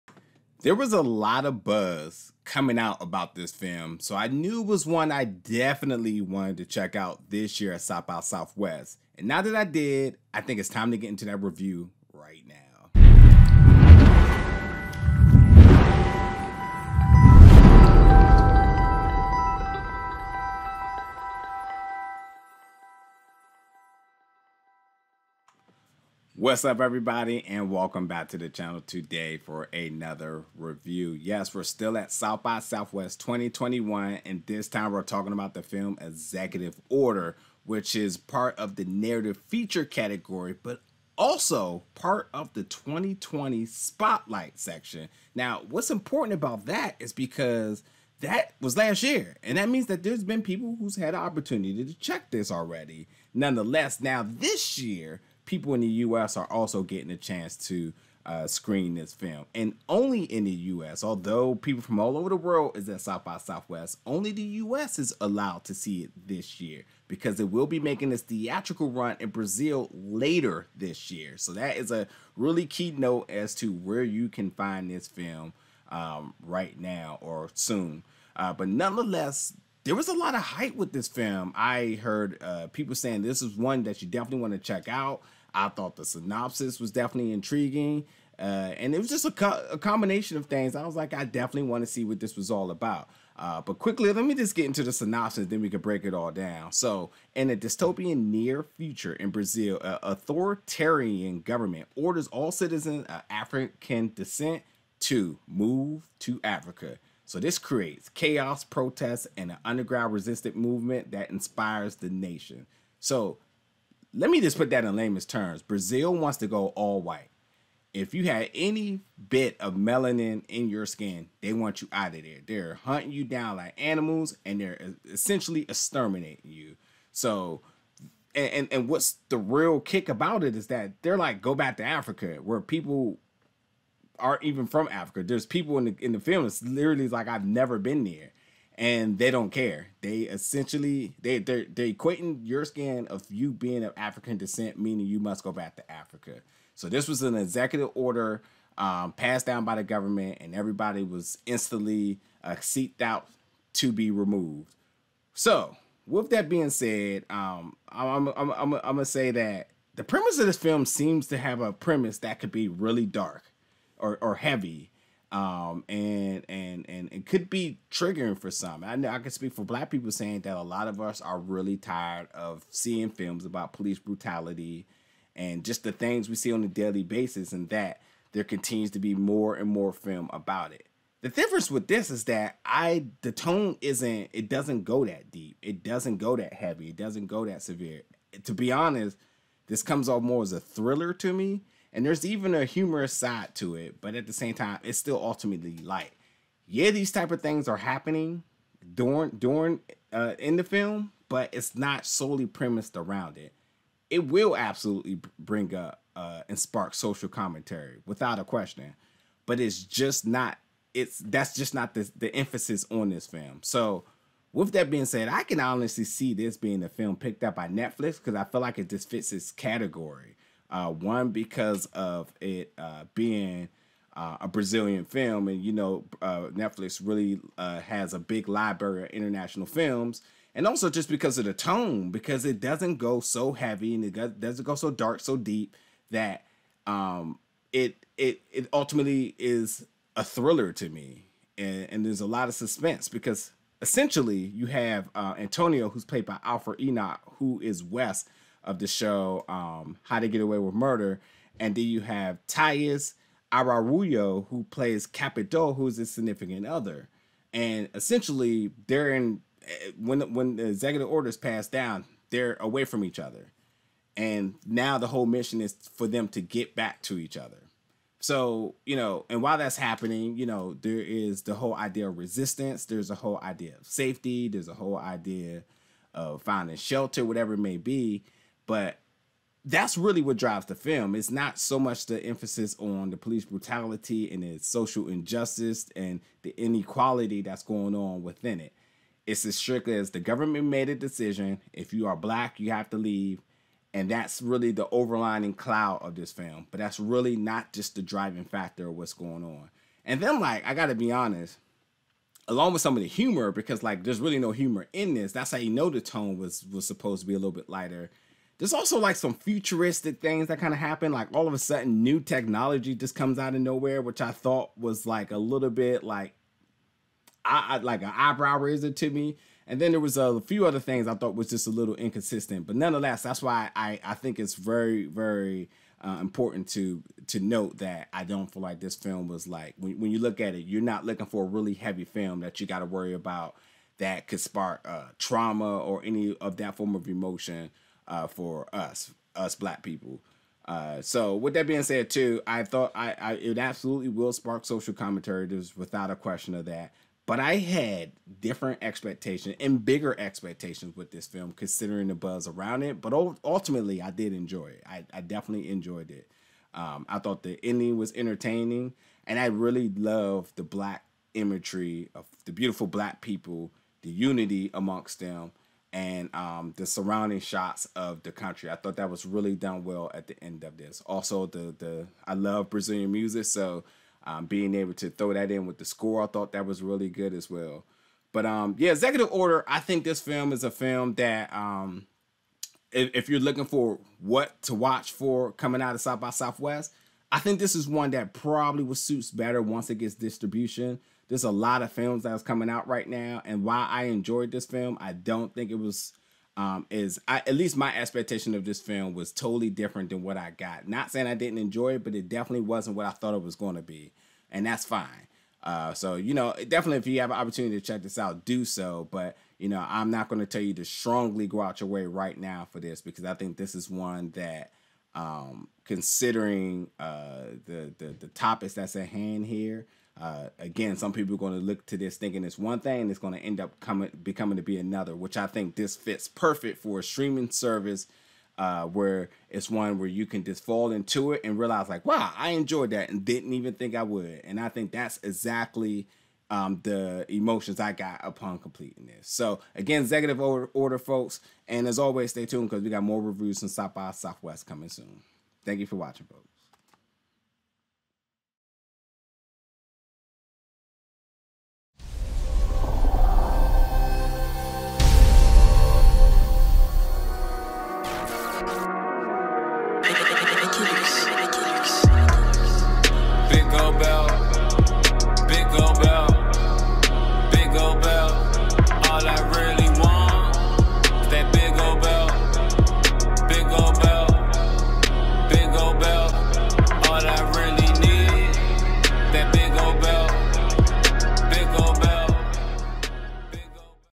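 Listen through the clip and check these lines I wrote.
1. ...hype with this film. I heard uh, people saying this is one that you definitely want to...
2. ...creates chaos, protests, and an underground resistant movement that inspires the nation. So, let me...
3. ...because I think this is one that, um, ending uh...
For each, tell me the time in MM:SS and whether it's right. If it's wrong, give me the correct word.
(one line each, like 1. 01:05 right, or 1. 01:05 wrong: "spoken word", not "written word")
1. 01:20 right
2. 01:47 right
3. 06:53 wrong: "considering", not "ending".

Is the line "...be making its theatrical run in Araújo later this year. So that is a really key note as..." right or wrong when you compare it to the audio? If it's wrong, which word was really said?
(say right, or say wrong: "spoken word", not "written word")
wrong: "Brazil", not "Araújo".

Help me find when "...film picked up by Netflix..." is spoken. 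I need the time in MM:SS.
03:36.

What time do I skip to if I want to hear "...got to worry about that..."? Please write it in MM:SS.
05:32.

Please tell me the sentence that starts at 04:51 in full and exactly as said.
If you are black, you have to leave.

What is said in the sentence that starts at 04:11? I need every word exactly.
And then you have Taís Araújo, who plays Capitu, who's his significant other.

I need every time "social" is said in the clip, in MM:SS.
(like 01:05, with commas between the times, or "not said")
03:26, 04:44, 05:44.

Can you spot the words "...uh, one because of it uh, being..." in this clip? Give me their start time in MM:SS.
03:40.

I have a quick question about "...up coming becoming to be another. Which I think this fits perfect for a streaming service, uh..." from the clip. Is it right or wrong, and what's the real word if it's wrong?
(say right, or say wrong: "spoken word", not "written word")
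right.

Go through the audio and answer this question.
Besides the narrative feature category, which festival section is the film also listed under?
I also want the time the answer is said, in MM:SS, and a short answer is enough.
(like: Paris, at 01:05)
2020 Spotlight, at 00:42.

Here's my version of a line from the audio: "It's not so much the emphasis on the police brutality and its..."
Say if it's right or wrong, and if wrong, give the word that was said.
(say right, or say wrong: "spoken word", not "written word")
right.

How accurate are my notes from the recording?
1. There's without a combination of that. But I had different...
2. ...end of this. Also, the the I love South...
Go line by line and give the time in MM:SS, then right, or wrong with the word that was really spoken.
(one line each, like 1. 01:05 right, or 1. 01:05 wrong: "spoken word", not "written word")
1. 05:45 wrong: "question", not "combination"
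2. 06:10 wrong: "Brazilian", not "South".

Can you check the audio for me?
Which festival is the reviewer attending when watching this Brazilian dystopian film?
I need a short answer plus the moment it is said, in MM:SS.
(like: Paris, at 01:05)
South by Southwest 2021, at 00:32.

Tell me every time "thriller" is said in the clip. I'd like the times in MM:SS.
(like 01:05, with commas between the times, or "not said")
03:10, 04:00.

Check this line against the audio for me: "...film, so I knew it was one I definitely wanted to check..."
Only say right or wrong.
right.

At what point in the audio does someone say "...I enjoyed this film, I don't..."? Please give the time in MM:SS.
06:33.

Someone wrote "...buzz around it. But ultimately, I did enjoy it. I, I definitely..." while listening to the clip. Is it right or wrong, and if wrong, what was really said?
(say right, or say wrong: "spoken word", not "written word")
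right.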